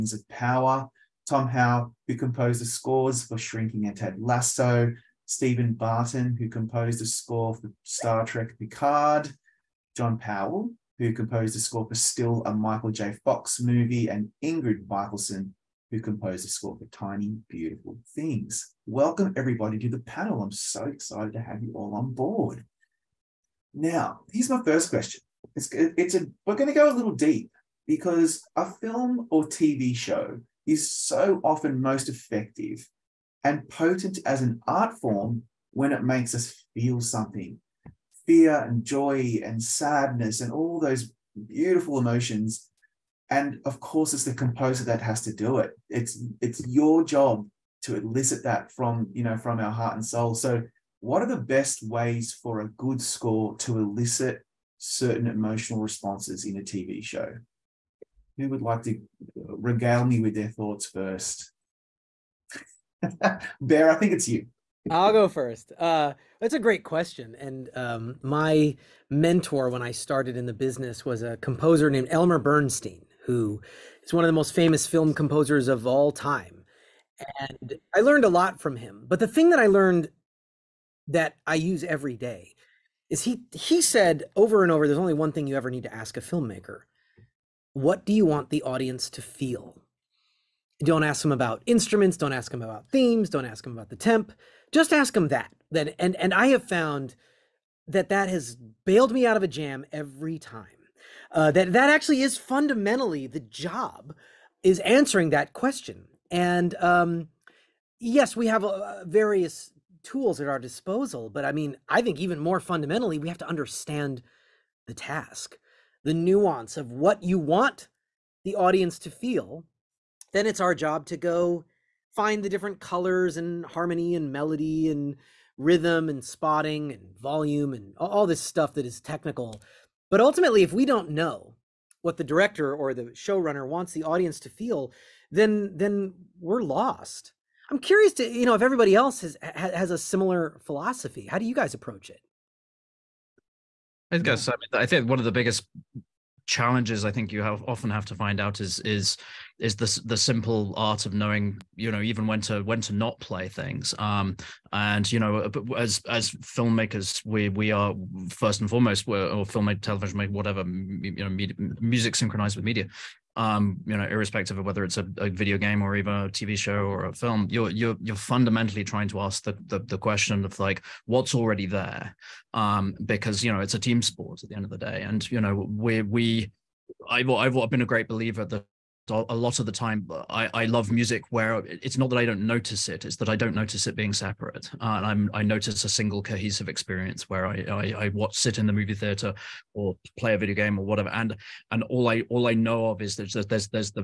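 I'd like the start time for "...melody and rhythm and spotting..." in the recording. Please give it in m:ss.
2:04.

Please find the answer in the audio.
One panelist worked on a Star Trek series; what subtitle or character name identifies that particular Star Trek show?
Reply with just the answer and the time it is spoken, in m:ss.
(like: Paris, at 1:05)
Picard, at 0:08.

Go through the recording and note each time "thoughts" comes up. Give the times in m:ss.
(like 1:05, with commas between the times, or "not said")
1:00.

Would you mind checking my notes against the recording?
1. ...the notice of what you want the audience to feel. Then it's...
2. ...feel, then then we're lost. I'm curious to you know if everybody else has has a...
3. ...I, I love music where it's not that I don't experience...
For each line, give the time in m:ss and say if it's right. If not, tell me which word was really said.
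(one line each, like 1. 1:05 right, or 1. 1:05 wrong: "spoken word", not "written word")
1. 1:56 wrong: "nuance", not "notice"
2. 2:14 right
3. 3:00 wrong: "notice", not "experience".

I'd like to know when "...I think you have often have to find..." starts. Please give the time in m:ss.
2:27.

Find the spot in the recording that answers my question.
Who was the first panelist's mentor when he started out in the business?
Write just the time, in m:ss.
1:12.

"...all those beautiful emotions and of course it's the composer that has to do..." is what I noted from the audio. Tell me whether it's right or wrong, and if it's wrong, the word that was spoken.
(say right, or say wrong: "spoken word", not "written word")
right.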